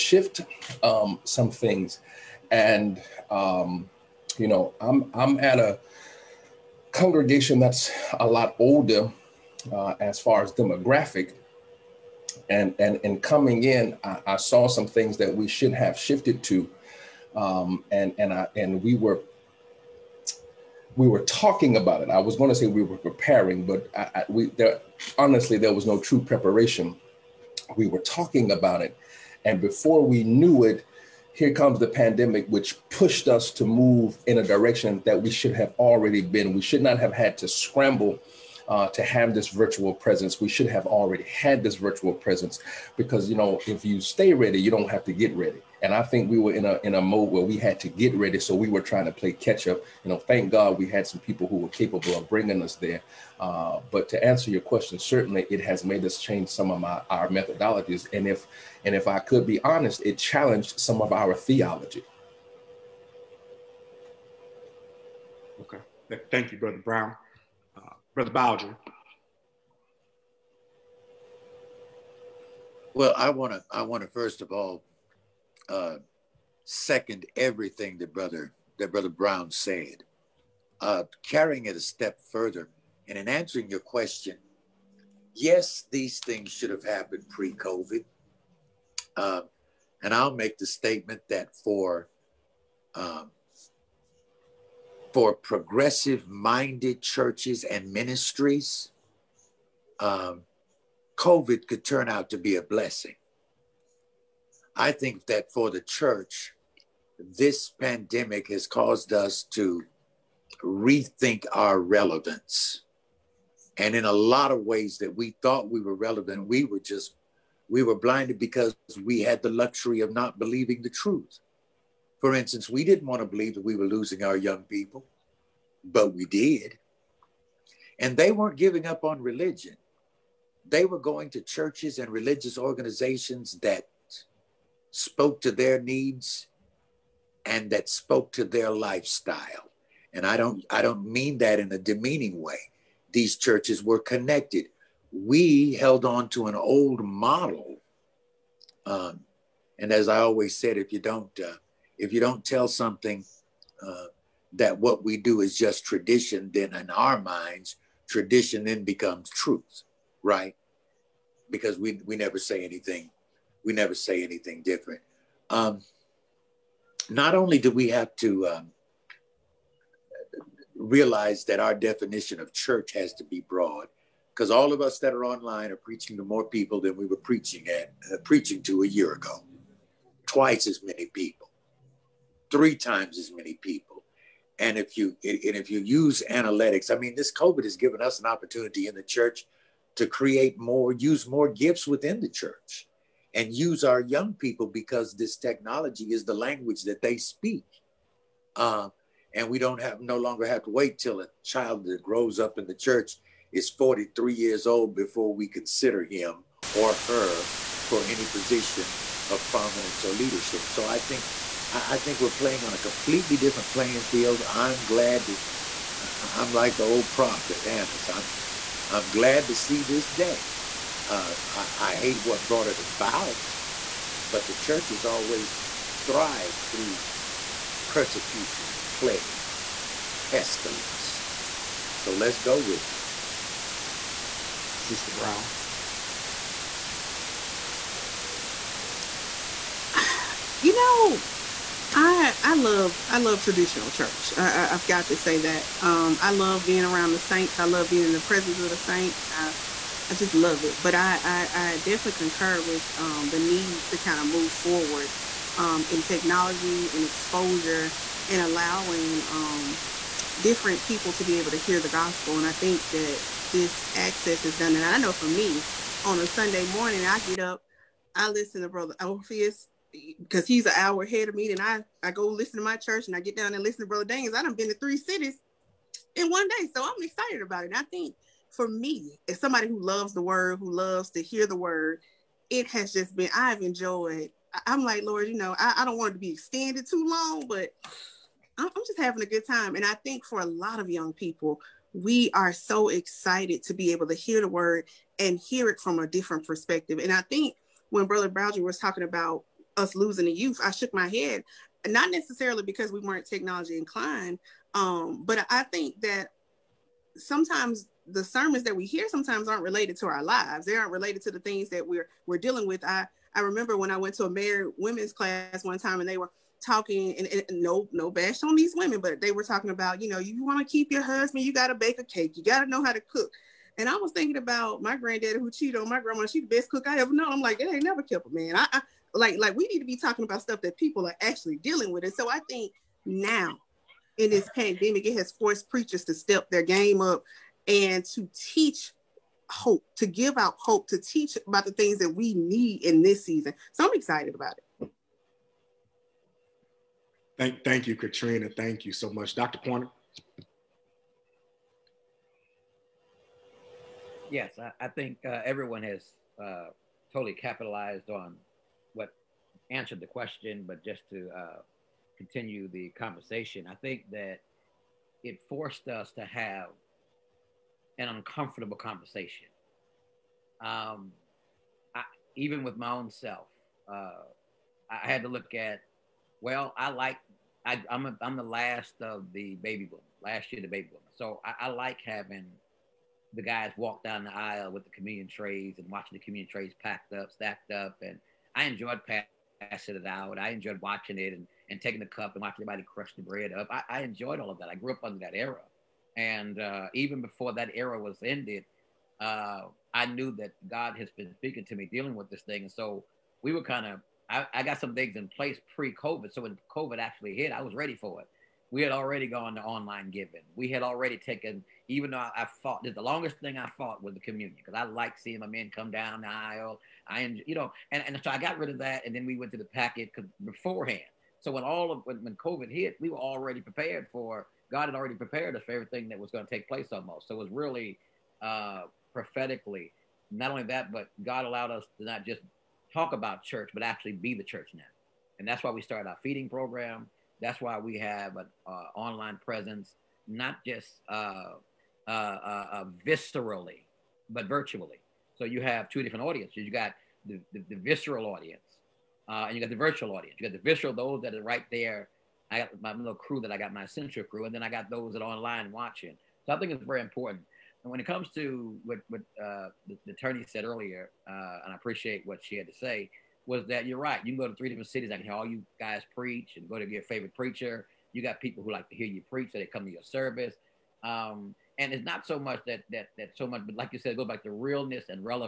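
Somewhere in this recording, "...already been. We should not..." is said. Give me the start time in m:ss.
0:35.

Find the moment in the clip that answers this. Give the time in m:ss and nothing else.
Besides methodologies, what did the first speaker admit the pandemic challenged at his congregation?
1:01.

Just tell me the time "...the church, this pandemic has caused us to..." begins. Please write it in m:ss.
1:45.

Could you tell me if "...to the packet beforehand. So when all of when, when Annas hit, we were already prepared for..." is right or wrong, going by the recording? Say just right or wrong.
wrong.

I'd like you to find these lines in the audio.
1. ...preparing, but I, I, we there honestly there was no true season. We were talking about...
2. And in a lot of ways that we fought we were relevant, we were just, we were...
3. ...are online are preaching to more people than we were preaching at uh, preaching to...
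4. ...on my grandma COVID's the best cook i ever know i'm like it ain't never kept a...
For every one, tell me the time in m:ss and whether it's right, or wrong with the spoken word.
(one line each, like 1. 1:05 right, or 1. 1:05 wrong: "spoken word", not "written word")
1. 0:22 wrong: "preparation", not "season"
2. 1:53 wrong: "thought", not "fought"
3. 2:55 right
4. 5:25 wrong: "She", not "COVID".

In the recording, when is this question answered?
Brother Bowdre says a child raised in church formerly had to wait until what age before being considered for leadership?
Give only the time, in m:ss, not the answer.
3:23.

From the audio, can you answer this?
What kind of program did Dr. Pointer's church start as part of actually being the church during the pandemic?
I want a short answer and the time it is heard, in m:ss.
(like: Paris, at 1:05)
feeding program, at 7:16.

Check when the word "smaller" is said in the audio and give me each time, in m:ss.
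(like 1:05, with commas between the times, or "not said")
not said.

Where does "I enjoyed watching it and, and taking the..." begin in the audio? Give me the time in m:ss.
6:30.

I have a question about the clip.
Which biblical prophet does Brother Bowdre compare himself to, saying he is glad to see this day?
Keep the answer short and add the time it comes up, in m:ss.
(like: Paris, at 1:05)
Annas, at 3:37.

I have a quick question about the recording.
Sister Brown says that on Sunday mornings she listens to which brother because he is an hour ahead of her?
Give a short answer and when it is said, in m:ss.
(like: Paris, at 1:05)
Brother Orpheus, at 4:28.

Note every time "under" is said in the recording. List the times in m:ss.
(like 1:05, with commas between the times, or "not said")
6:35.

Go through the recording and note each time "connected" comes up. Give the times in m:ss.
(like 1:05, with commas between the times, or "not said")
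2:23.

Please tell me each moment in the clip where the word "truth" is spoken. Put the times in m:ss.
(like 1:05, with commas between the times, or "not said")
2:00, 2:39.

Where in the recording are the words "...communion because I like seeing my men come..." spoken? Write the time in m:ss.
6:54.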